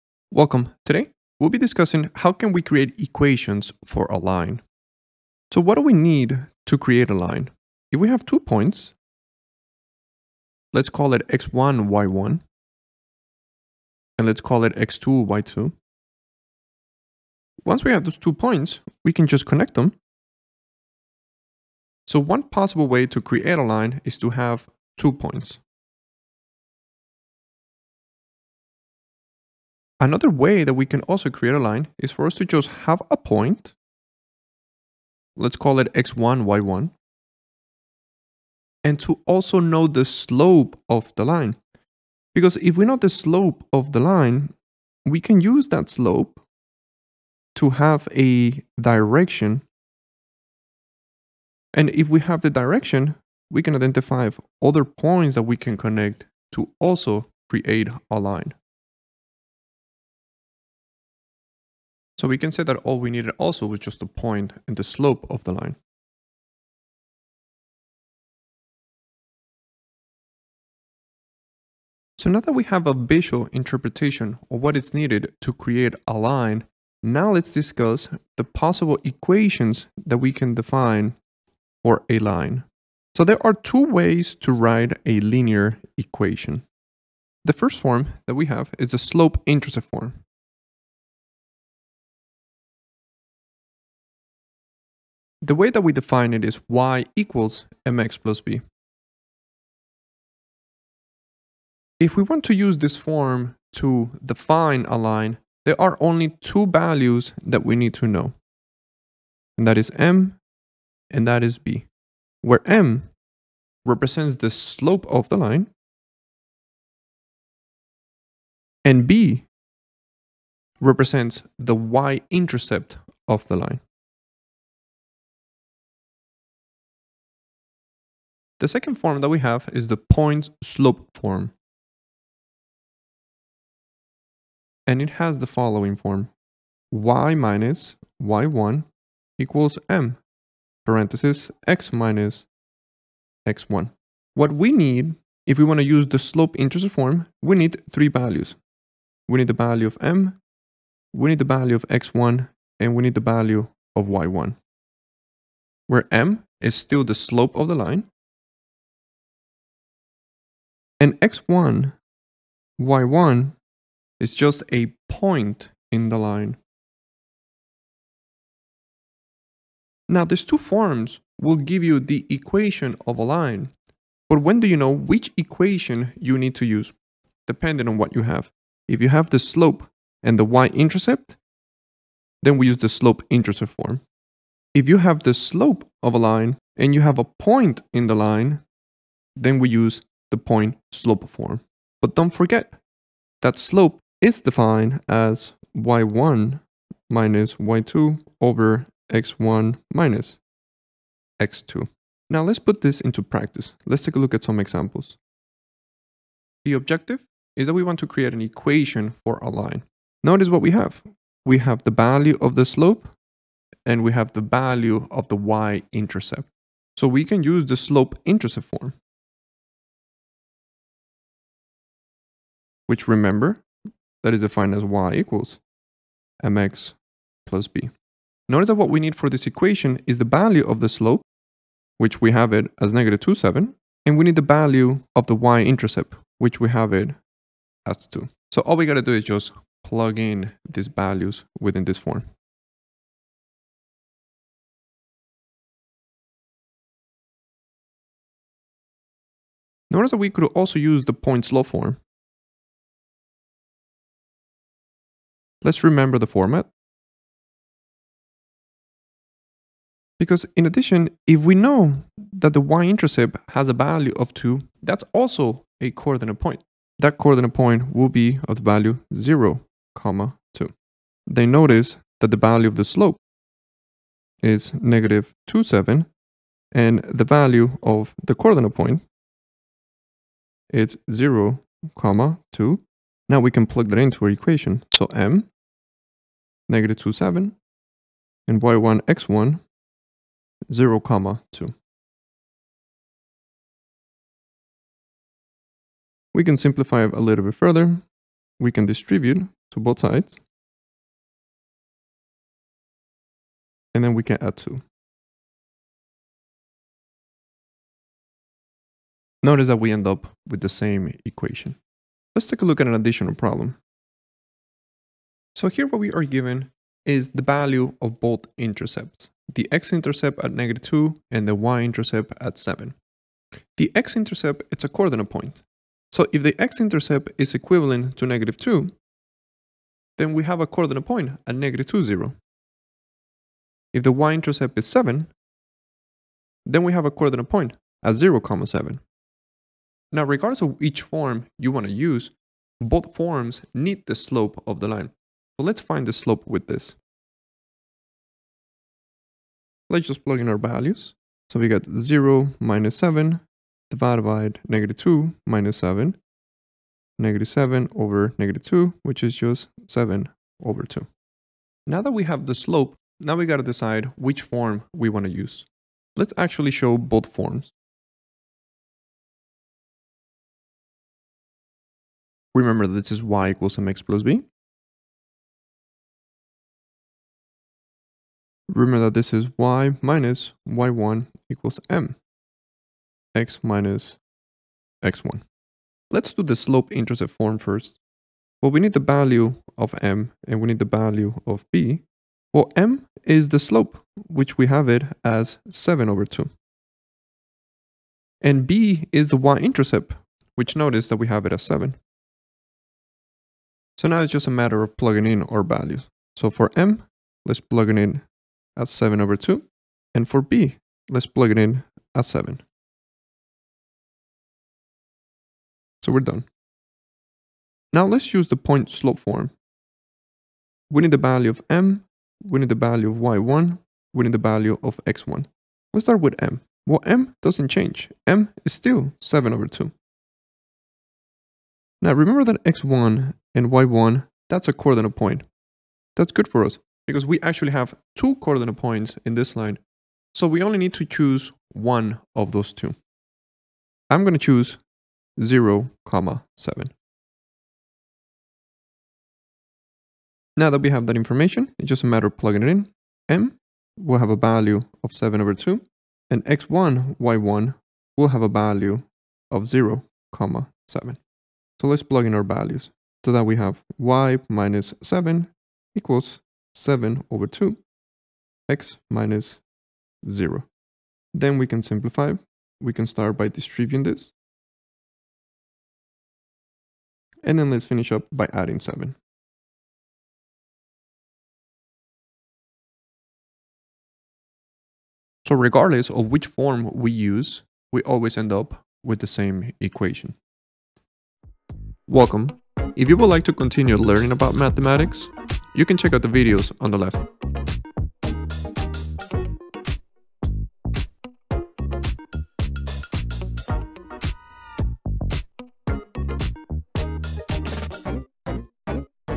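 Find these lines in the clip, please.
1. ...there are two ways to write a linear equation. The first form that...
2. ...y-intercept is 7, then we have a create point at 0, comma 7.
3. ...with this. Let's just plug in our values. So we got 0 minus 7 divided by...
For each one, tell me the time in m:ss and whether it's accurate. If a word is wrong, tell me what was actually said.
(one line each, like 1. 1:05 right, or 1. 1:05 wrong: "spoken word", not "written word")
1. 1:23 right
2. 5:34 wrong: "coordinate", not "create"
3. 5:46 right.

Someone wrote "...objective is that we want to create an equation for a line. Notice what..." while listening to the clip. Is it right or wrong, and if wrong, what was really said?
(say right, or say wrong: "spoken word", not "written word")
right.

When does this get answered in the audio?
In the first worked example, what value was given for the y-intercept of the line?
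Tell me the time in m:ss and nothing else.
3:56.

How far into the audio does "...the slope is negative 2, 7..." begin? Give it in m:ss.
4:32.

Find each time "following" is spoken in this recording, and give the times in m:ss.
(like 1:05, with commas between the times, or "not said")
2:15.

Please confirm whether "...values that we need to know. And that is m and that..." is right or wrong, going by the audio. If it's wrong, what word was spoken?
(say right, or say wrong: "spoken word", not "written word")
right.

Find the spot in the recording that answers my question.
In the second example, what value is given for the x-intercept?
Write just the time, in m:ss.
5:19.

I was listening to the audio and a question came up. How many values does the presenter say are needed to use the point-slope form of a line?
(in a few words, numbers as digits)
3.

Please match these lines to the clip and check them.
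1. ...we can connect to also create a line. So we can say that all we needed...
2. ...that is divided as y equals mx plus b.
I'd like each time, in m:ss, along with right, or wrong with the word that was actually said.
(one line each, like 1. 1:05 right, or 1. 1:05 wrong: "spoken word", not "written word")
1. 0:55 right
2. 3:44 wrong: "defined", not "divided".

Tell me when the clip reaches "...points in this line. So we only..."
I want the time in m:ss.
7:18.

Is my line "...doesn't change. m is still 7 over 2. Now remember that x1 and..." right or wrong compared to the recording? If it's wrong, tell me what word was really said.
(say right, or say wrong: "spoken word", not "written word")
right.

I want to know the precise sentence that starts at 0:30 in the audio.
Another way that we can also create a line is for us to just have a point.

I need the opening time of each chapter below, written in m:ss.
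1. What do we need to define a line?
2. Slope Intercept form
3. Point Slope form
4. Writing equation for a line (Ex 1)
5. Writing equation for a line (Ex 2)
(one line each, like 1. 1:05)
1. 0:10
2. 1:26
3. 2:07
4. 3:25
5. 5:14.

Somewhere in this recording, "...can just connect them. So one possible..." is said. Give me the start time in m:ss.
0:19.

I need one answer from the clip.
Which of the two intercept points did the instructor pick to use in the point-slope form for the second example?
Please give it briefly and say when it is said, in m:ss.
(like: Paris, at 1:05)
(0, 7), at 7:24.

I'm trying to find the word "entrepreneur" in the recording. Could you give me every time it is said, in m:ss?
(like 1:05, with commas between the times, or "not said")
not said.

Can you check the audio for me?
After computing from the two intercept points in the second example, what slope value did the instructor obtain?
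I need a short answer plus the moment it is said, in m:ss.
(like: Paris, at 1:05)
7/2, at 5:59.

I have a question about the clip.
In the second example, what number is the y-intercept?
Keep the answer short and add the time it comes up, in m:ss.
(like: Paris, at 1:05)
7, at 5:21.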